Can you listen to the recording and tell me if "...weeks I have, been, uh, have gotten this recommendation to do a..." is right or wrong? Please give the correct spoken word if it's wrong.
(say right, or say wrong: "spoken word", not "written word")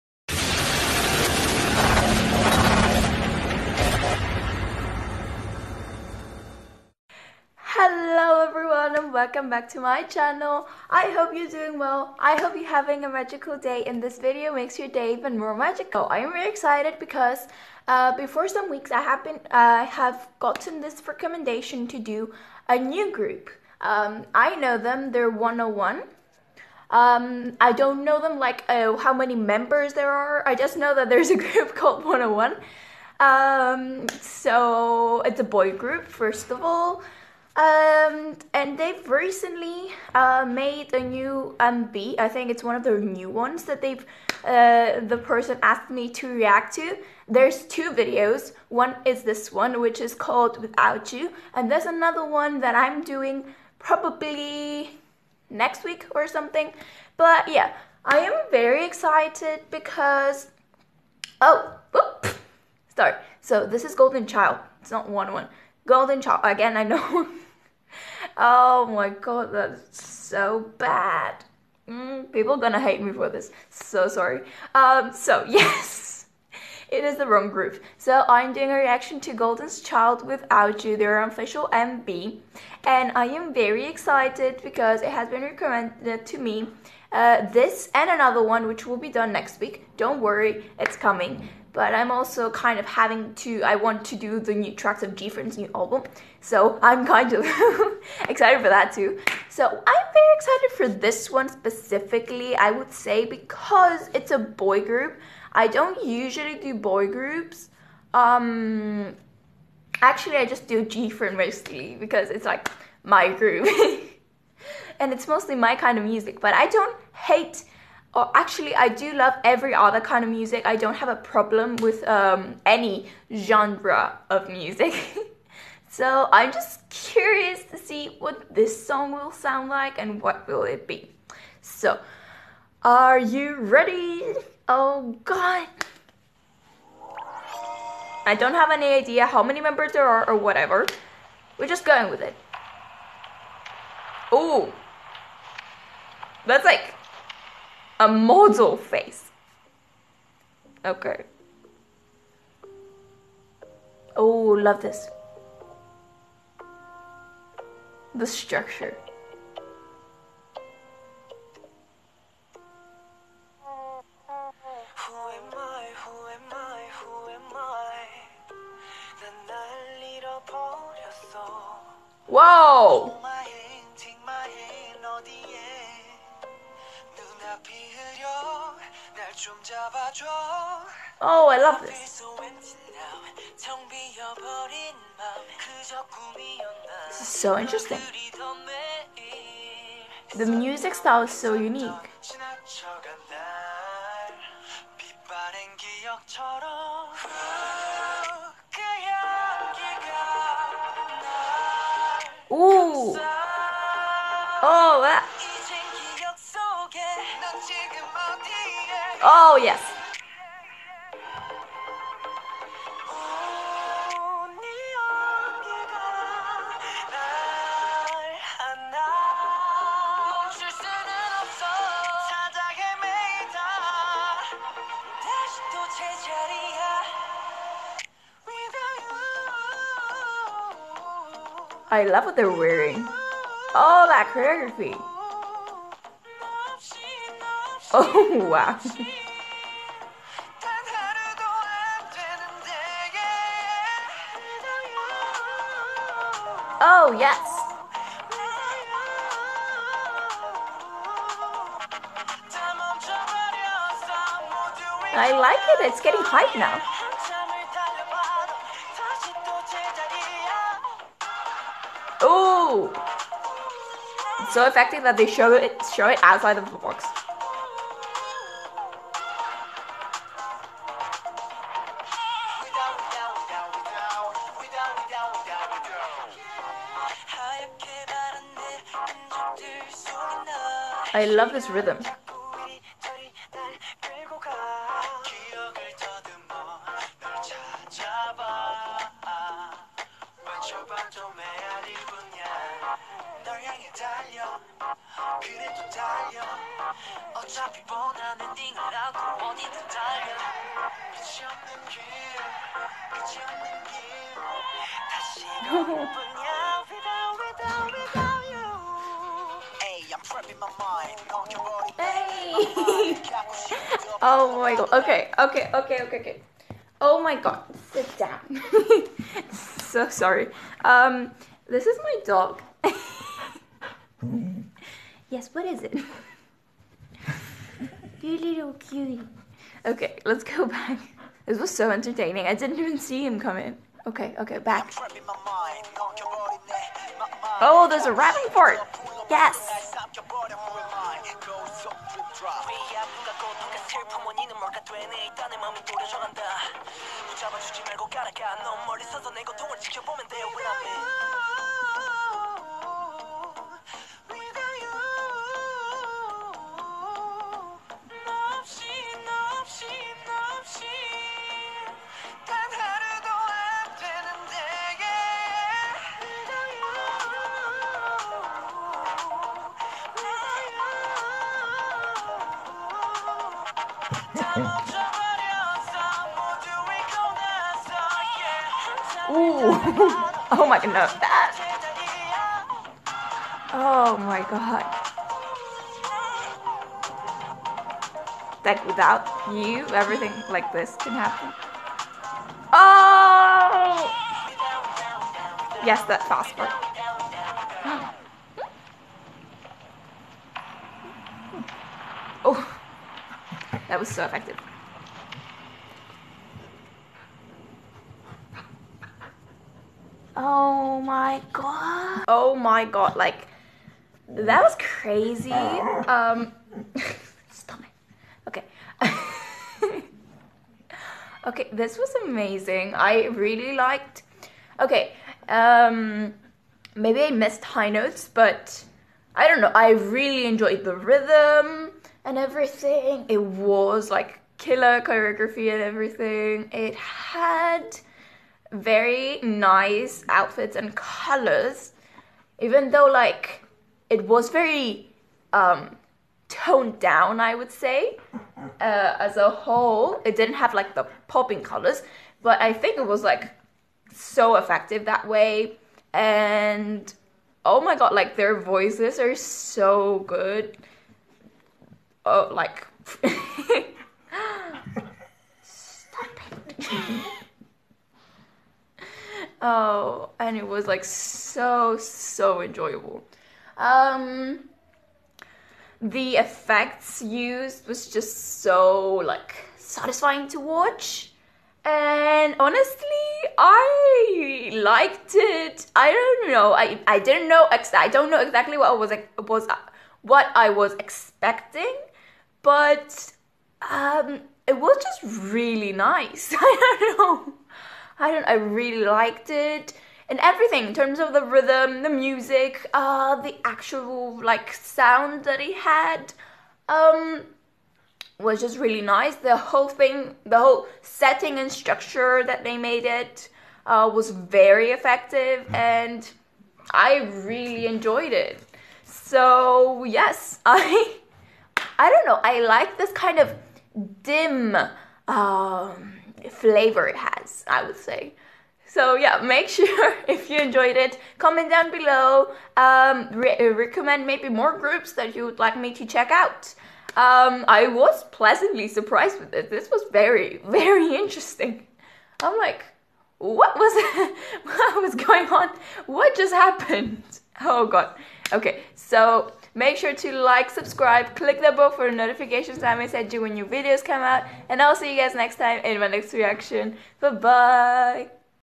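right.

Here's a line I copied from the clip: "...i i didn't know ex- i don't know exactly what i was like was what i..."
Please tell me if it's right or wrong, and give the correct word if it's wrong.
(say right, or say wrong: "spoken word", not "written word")
right.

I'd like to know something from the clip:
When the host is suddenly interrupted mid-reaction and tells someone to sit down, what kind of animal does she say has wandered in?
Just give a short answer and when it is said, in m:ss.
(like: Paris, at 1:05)
Dog, at 5:22.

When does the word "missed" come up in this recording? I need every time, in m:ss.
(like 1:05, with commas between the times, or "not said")
7:07.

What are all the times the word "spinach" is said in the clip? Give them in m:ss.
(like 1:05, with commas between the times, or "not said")
not said.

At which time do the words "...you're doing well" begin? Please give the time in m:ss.
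0:11.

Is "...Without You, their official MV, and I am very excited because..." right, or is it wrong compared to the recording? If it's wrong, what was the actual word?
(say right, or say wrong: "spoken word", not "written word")
right.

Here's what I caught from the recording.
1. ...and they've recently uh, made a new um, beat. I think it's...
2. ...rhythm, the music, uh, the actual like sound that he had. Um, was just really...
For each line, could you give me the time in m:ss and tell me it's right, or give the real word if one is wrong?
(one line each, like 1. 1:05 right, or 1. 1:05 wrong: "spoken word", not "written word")
1. 0:38 right
2. 8:21 right.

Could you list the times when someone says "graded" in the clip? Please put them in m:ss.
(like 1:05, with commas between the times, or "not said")
not said.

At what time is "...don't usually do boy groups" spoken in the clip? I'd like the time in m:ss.
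1:45.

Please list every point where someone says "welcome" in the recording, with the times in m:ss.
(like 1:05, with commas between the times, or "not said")
0:09.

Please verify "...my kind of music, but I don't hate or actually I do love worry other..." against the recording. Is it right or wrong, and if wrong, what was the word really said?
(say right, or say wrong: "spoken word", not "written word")
wrong: "every", not "worry".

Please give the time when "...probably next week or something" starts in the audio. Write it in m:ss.
0:53.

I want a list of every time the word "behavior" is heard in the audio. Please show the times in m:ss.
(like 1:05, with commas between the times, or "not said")
not said.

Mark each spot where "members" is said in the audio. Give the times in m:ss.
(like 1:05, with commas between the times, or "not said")
0:29, 2:19.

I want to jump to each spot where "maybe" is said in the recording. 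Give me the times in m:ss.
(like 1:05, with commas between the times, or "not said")
7:06, 8:54.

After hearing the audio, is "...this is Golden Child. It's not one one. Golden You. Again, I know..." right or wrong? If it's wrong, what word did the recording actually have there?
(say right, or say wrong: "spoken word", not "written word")
wrong: "Child", not "You".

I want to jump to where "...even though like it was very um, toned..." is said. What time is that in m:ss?
7:22.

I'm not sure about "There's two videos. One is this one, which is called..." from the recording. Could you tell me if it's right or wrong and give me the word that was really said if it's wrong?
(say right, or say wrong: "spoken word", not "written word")
right.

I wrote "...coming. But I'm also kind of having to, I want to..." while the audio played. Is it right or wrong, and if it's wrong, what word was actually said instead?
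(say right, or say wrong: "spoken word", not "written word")
right.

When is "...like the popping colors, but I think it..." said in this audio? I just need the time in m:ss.
7:30.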